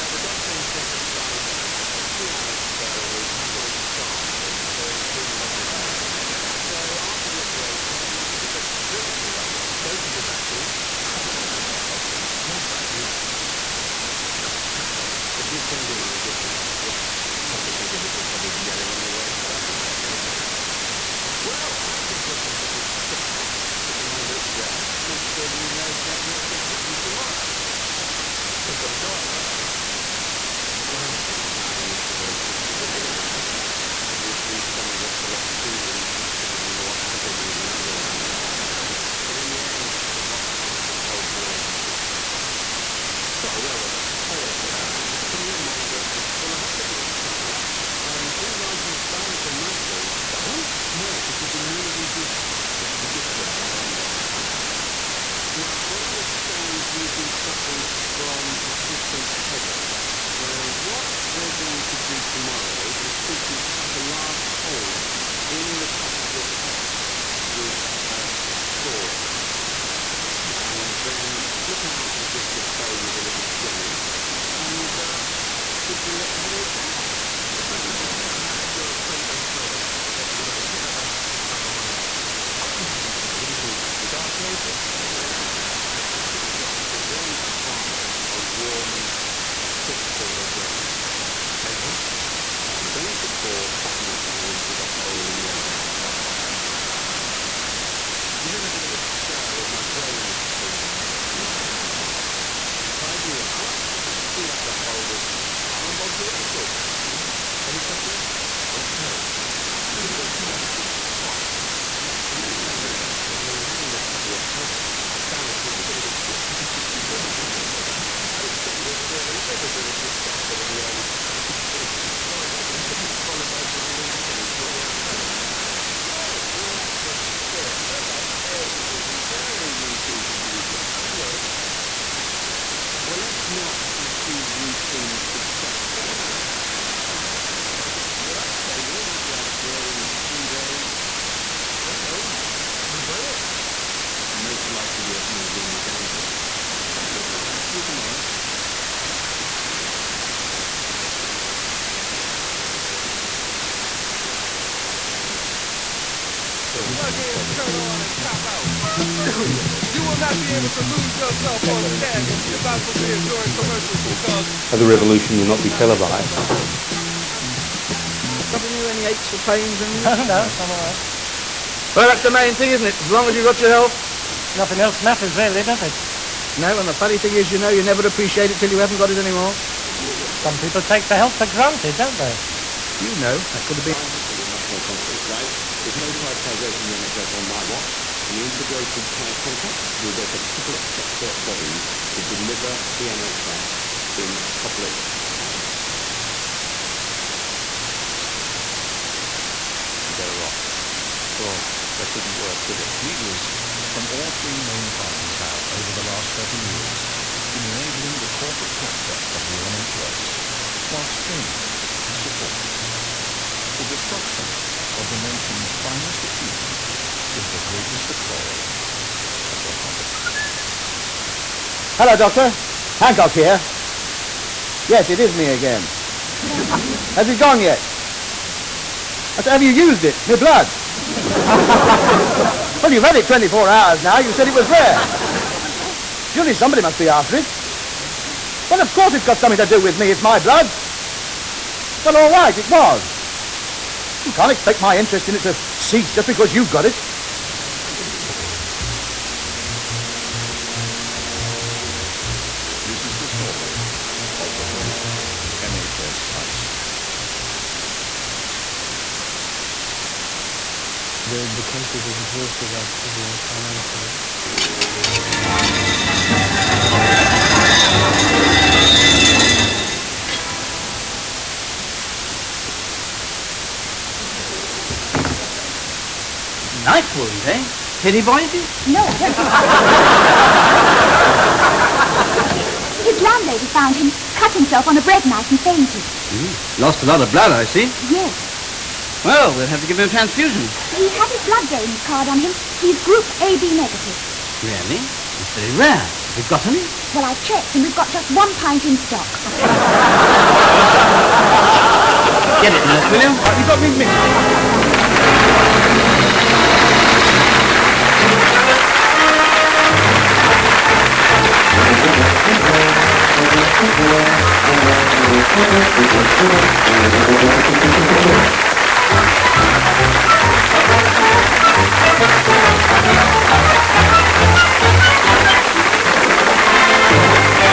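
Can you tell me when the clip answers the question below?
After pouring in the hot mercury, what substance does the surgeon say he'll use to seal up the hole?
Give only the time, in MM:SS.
01:45.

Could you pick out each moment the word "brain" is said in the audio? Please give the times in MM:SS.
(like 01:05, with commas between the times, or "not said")
01:30, 01:39.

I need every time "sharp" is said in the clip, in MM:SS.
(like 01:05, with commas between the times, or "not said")
00:03.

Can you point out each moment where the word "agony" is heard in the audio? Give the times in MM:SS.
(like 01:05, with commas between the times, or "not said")
00:36, 02:04.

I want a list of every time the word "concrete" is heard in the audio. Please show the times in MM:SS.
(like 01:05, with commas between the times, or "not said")
03:04.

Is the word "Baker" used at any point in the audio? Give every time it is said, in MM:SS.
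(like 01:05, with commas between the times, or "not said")
00:32.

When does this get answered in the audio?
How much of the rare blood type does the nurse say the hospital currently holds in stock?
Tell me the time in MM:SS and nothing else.
04:58.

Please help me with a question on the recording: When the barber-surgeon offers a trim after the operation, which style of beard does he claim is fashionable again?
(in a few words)
Goatees.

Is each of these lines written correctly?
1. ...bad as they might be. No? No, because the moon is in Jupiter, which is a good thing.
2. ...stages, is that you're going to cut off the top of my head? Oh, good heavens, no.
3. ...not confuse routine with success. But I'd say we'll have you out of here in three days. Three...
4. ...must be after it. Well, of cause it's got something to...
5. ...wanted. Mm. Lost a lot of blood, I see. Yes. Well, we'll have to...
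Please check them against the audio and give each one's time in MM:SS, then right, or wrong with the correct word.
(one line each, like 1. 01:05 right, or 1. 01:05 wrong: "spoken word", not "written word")
1. 00:48 right
2. 01:19 wrong: "headaches", not "stages"
3. 02:13 right
4. 03:56 wrong: "course", not "cause"
5. 04:45 wrong: "fainted", not "wanted".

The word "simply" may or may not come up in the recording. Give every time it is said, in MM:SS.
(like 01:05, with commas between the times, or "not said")
01:03, 01:15.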